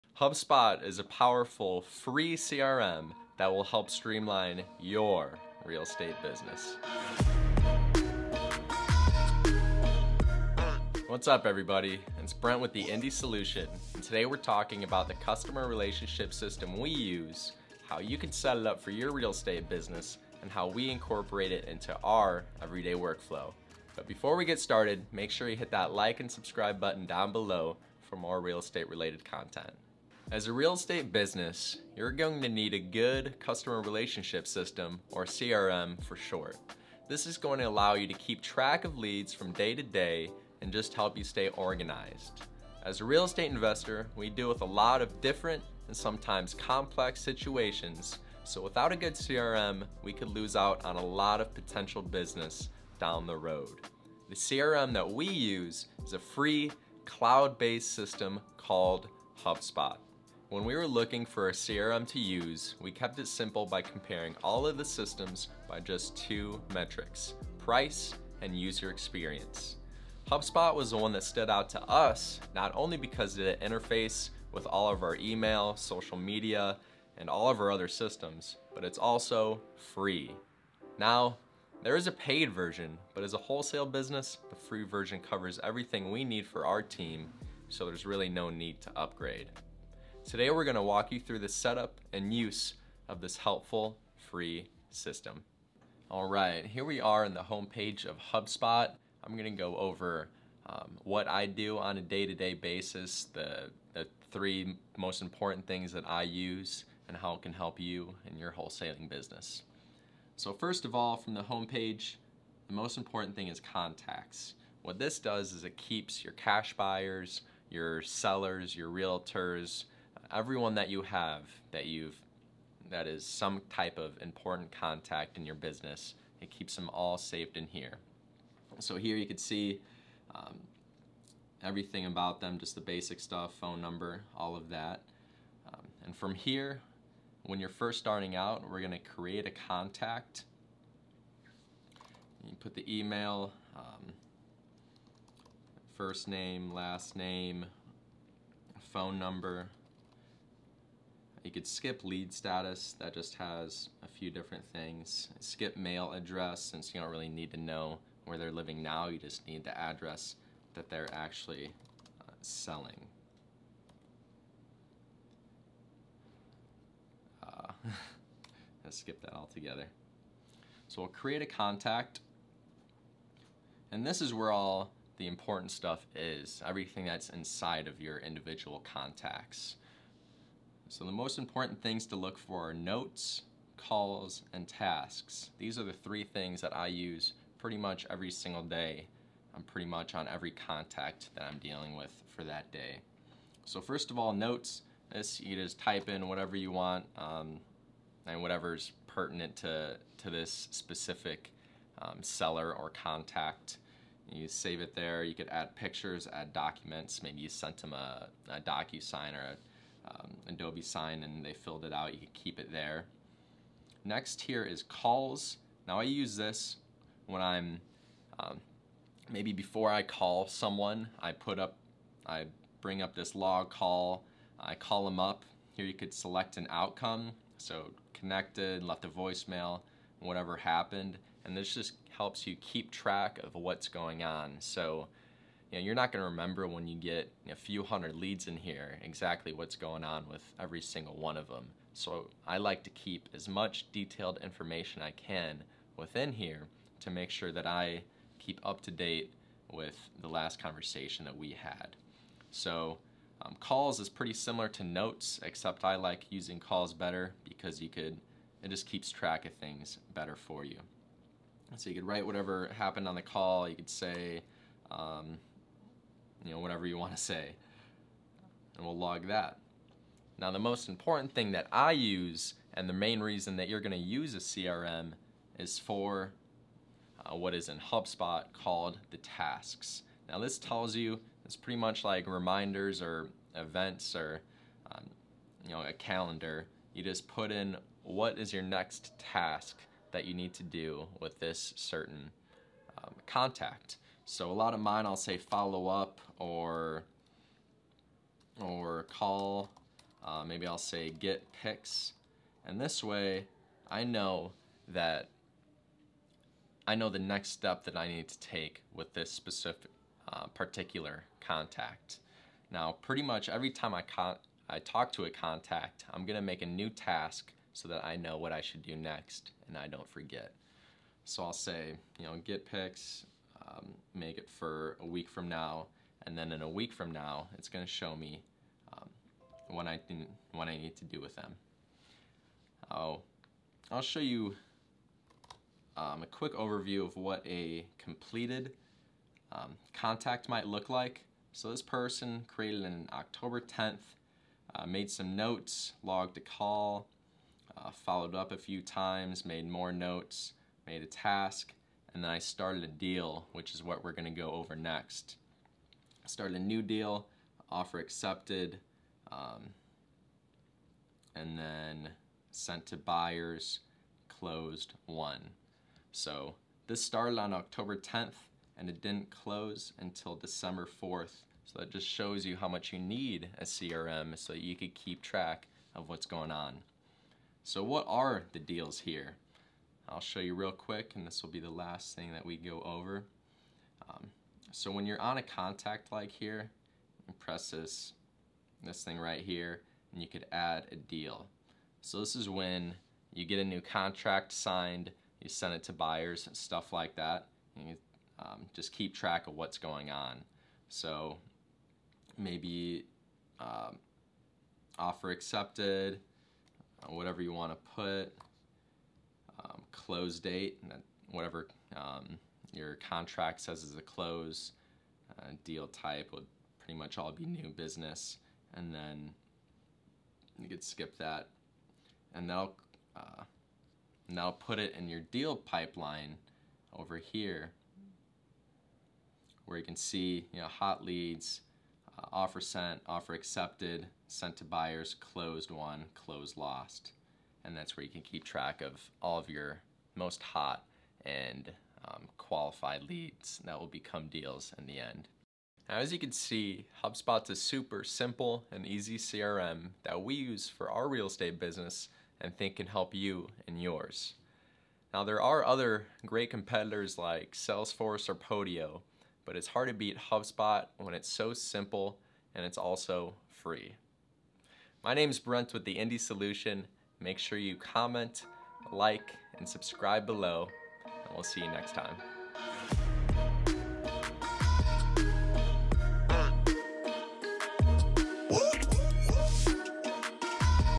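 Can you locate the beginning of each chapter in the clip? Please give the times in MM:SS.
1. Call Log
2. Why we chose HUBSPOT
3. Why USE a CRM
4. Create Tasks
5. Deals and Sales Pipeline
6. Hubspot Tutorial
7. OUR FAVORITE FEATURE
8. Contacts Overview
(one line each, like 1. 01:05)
1. 03:33
2. 01:00
3. 00:30
4. 03:14
5. 06:23
6. 01:35
7. 04:30
8. 01:50.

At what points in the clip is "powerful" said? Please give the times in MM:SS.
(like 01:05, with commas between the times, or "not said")
00:01.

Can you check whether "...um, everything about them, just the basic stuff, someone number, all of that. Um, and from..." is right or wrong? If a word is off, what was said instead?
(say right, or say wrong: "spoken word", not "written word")
wrong: "phone", not "someone".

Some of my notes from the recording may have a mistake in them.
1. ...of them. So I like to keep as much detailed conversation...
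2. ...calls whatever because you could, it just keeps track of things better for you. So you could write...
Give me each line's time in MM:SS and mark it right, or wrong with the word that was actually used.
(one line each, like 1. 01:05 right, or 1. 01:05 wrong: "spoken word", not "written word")
1. 04:01 wrong: "information", not "conversation"
2. 04:16 wrong: "better", not "whatever".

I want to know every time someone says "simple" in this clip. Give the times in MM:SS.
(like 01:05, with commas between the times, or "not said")
01:03, 07:28, 07:41.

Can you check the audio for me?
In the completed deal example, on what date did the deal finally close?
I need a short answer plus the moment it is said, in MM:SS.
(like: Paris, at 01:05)
December 4, at 06:10.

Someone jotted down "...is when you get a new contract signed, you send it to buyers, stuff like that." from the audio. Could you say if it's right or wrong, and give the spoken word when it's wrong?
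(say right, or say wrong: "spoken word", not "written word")
right.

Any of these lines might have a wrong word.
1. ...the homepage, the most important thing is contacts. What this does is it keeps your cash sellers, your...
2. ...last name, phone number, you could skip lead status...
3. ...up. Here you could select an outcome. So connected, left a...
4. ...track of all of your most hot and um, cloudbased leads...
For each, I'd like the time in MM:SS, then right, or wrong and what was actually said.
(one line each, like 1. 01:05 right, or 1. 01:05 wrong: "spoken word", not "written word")
1. 01:51 wrong: "buyers", not "sellers"
2. 02:26 right
3. 03:45 right
4. 07:18 wrong: "qualified", not "cloudbased".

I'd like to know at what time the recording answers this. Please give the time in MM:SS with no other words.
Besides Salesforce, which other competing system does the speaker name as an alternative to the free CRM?
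07:38.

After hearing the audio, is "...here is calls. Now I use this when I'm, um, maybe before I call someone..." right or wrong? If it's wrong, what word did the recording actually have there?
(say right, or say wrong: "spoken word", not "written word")
right.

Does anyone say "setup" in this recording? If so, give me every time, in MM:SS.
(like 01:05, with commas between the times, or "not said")
01:31.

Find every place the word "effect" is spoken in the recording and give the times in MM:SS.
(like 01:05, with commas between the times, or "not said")
not said.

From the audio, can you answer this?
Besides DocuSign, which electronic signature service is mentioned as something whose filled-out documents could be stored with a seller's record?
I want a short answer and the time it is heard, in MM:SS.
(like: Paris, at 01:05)
Adobe Sign, at 03:30.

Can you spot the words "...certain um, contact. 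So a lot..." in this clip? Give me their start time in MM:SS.
04:51.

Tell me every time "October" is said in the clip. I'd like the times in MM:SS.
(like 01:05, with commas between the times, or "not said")
05:43, 06:07.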